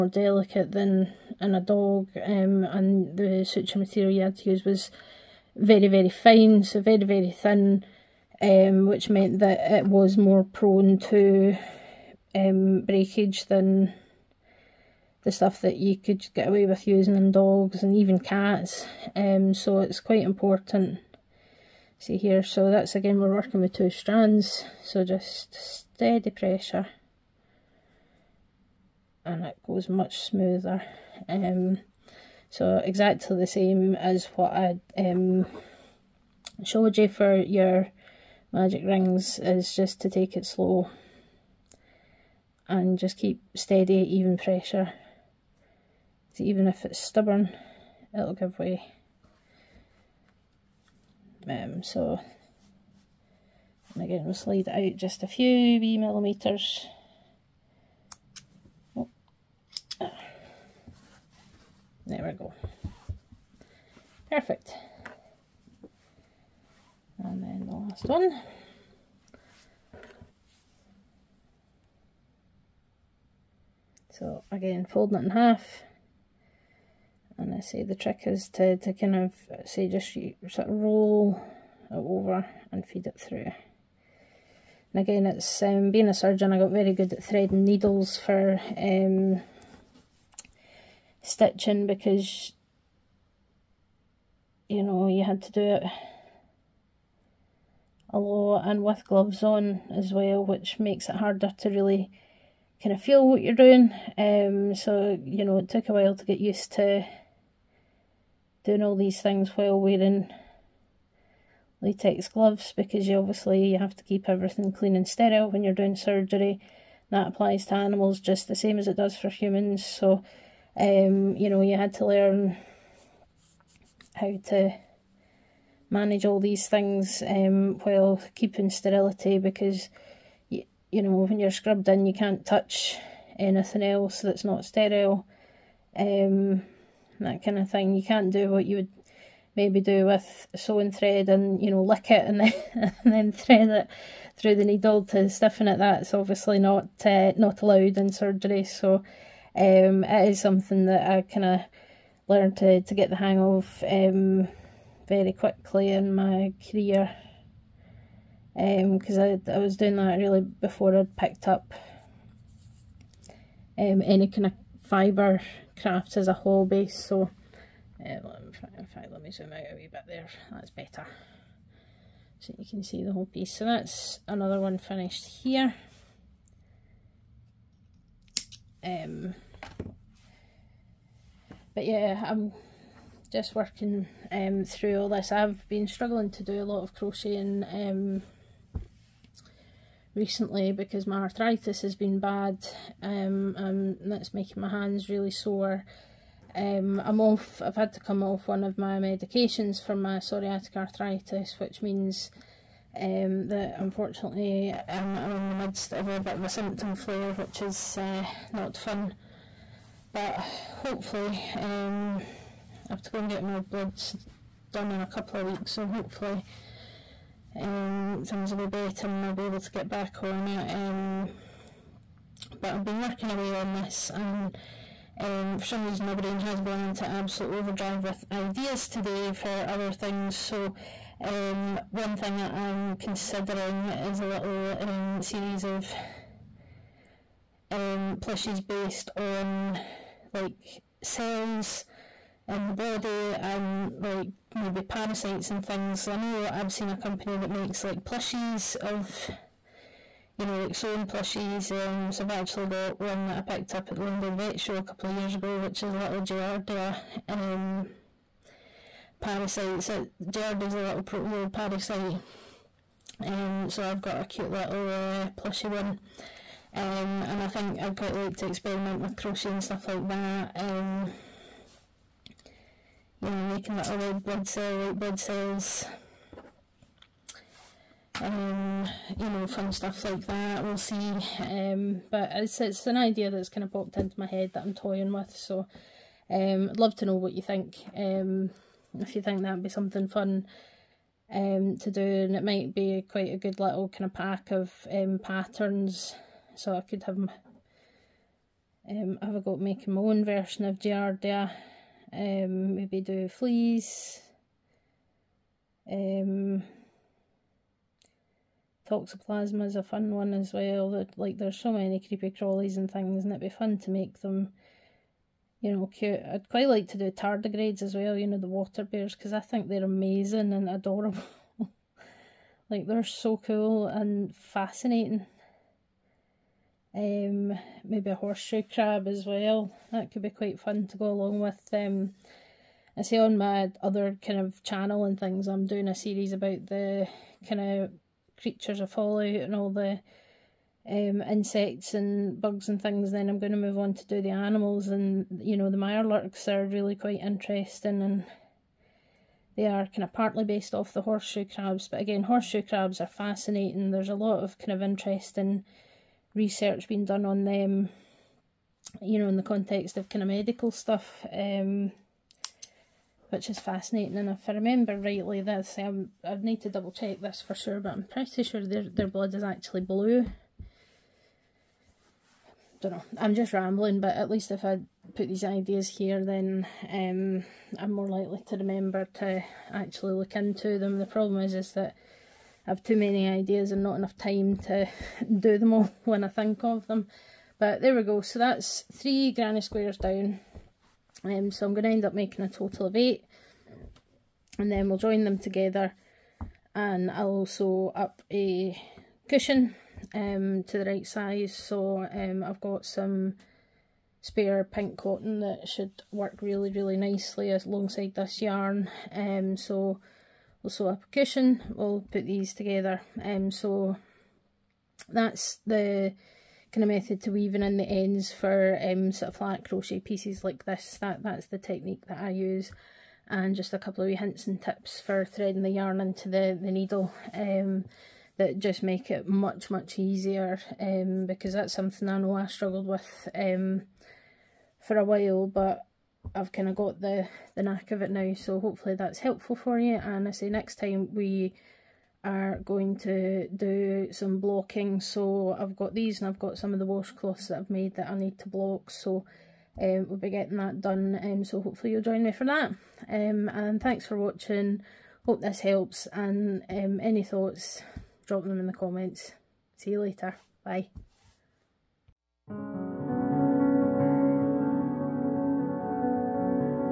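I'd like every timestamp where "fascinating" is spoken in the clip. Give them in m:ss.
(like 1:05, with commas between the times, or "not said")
5:24, 5:53, 6:03.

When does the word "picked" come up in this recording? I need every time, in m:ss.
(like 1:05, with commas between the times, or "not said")
2:41, 4:13.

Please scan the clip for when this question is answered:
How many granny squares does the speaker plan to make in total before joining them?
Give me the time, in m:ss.
6:32.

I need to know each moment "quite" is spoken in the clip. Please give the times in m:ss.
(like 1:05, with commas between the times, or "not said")
0:20, 4:27, 4:53, 5:16, 5:30, 5:46.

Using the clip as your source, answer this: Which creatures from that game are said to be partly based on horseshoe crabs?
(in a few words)
Mirelurks.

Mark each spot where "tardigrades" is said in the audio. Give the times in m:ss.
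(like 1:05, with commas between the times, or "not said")
5:17.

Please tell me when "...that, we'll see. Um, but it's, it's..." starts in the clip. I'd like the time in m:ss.
4:40.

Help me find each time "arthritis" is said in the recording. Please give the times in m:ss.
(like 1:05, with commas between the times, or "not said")
3:11, 3:20.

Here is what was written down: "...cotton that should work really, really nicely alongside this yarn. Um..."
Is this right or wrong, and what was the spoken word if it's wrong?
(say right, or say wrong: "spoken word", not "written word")
right.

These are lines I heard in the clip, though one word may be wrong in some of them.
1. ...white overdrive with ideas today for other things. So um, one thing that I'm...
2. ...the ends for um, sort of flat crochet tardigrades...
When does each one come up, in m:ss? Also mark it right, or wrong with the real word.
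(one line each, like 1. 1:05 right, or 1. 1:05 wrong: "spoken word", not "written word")
1. 3:47 wrong: "absolute", not "white"
2. 6:57 wrong: "pieces", not "tardigrades".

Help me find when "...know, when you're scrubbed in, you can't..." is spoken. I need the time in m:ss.
2:11.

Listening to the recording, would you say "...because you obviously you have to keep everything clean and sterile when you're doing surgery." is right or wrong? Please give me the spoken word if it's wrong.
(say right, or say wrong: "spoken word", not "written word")
right.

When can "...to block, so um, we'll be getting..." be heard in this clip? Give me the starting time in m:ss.
7:28.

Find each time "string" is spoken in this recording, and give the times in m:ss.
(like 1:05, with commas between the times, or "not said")
not said.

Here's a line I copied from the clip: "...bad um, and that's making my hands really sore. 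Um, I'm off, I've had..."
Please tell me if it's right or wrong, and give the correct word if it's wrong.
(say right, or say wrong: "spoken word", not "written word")
right.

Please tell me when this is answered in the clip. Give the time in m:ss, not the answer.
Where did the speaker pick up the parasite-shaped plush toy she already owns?
4:14.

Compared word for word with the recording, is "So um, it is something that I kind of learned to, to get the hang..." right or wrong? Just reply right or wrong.
right.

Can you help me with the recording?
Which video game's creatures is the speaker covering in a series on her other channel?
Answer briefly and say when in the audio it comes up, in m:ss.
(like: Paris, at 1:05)
Fallout, at 5:38.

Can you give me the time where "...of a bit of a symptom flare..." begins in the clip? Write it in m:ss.
3:25.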